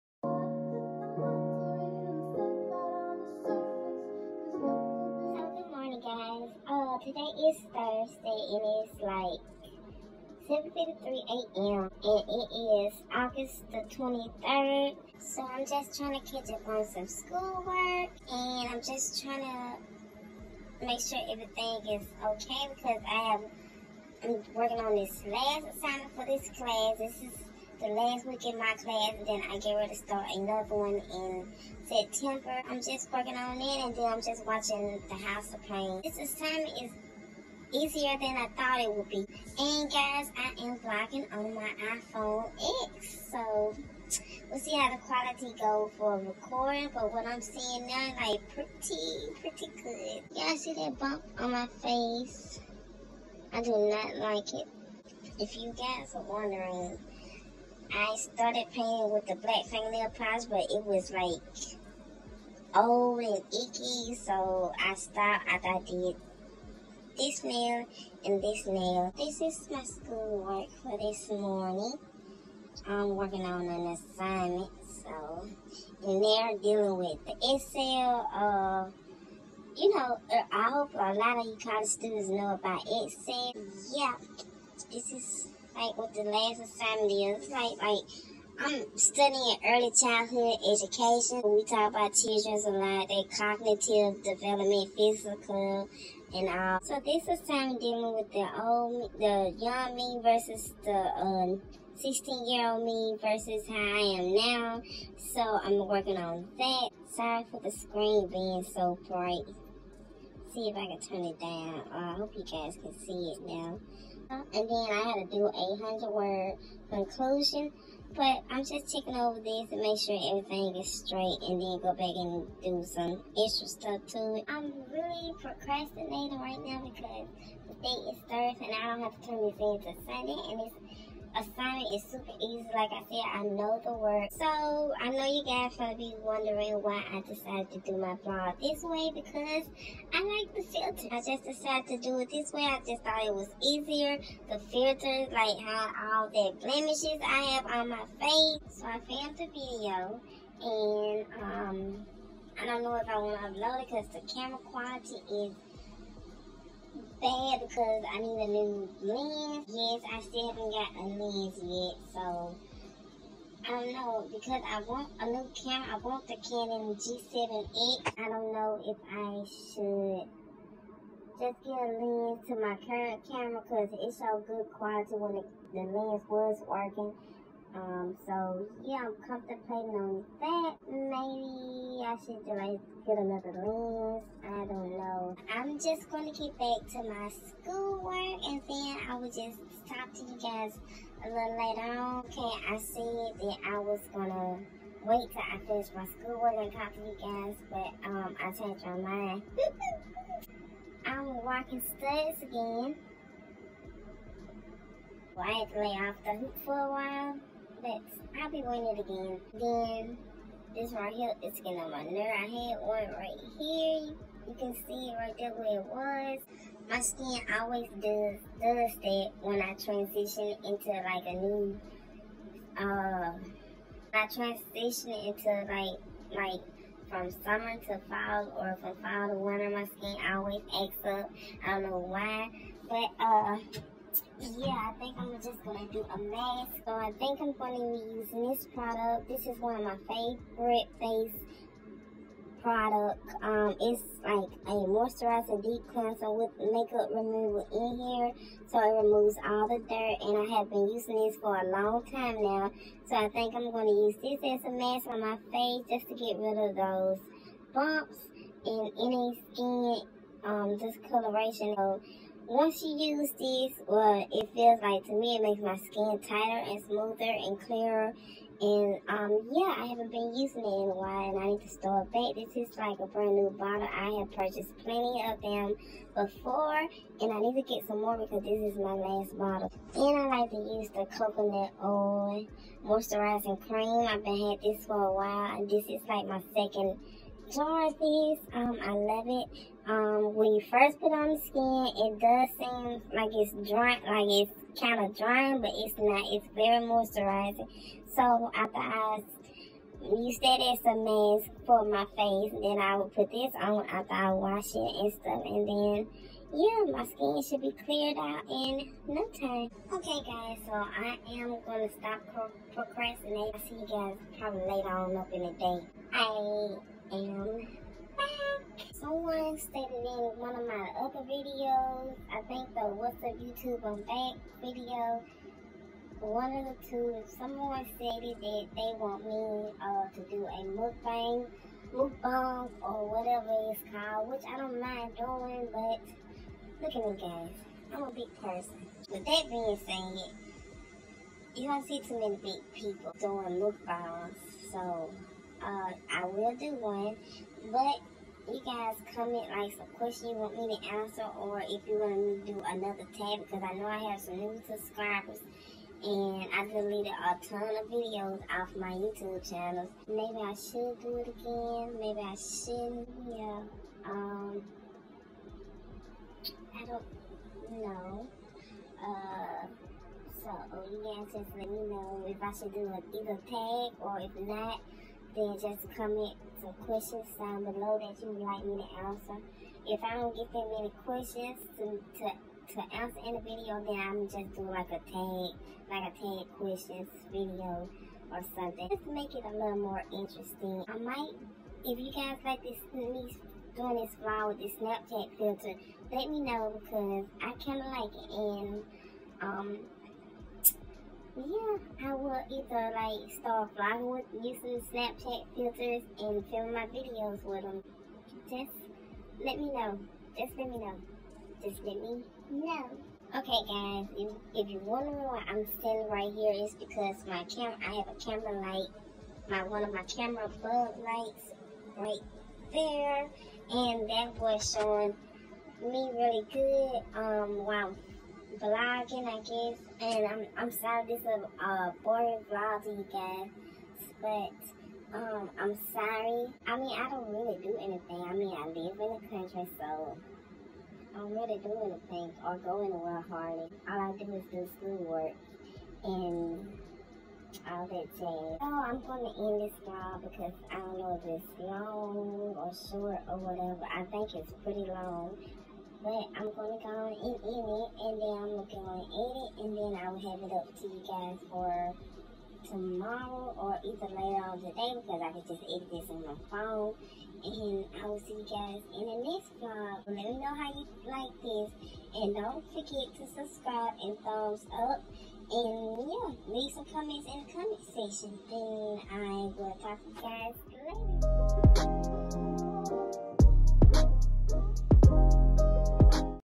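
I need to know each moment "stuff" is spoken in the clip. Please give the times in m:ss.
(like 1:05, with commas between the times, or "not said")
2:03, 5:05.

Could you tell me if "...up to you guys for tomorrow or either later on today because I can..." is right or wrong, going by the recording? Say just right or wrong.
right.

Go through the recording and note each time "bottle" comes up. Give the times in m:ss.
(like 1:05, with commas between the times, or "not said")
4:33, 4:39.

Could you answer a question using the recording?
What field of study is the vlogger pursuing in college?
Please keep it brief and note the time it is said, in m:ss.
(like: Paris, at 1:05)
Early childhood education, at 1:29.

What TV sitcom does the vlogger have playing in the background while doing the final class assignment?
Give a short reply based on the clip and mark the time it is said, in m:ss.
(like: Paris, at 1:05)
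The House of Payne, at 0:35.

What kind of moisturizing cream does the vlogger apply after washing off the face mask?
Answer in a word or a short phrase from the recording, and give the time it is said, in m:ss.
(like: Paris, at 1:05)
Coconut oil moisturizing cream, at 4:41.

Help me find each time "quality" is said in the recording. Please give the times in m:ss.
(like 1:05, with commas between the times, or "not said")
0:45, 2:34, 2:54.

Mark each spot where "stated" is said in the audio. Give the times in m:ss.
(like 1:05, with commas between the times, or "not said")
5:19, 5:27.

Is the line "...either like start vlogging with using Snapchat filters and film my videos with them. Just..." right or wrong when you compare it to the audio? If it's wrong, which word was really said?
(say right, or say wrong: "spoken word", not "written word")
right.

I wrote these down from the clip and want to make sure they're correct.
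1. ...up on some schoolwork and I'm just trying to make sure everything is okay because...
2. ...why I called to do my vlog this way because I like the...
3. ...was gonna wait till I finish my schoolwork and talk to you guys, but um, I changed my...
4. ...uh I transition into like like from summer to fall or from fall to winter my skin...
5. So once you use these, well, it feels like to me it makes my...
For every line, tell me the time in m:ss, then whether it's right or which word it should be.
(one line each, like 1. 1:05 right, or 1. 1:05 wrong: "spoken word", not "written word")
1. 0:16 right
2. 2:16 wrong: "decided", not "called"
3. 3:13 right
4. 3:42 right
5. 4:21 right.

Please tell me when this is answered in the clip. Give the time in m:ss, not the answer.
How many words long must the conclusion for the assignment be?
1:55.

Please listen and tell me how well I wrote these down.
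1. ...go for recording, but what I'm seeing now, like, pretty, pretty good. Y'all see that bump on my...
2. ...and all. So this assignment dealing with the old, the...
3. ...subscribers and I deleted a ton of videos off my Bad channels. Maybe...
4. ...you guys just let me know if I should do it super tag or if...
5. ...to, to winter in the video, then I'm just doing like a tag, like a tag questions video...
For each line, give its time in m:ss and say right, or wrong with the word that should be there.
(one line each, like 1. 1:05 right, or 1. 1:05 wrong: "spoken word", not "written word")
1. 0:45 right
2. 1:36 right
3. 5:54 wrong: "YouTube", not "Bad"
4. 6:10 wrong: "either", not "super"
5. 6:21 wrong: "answer", not "winter".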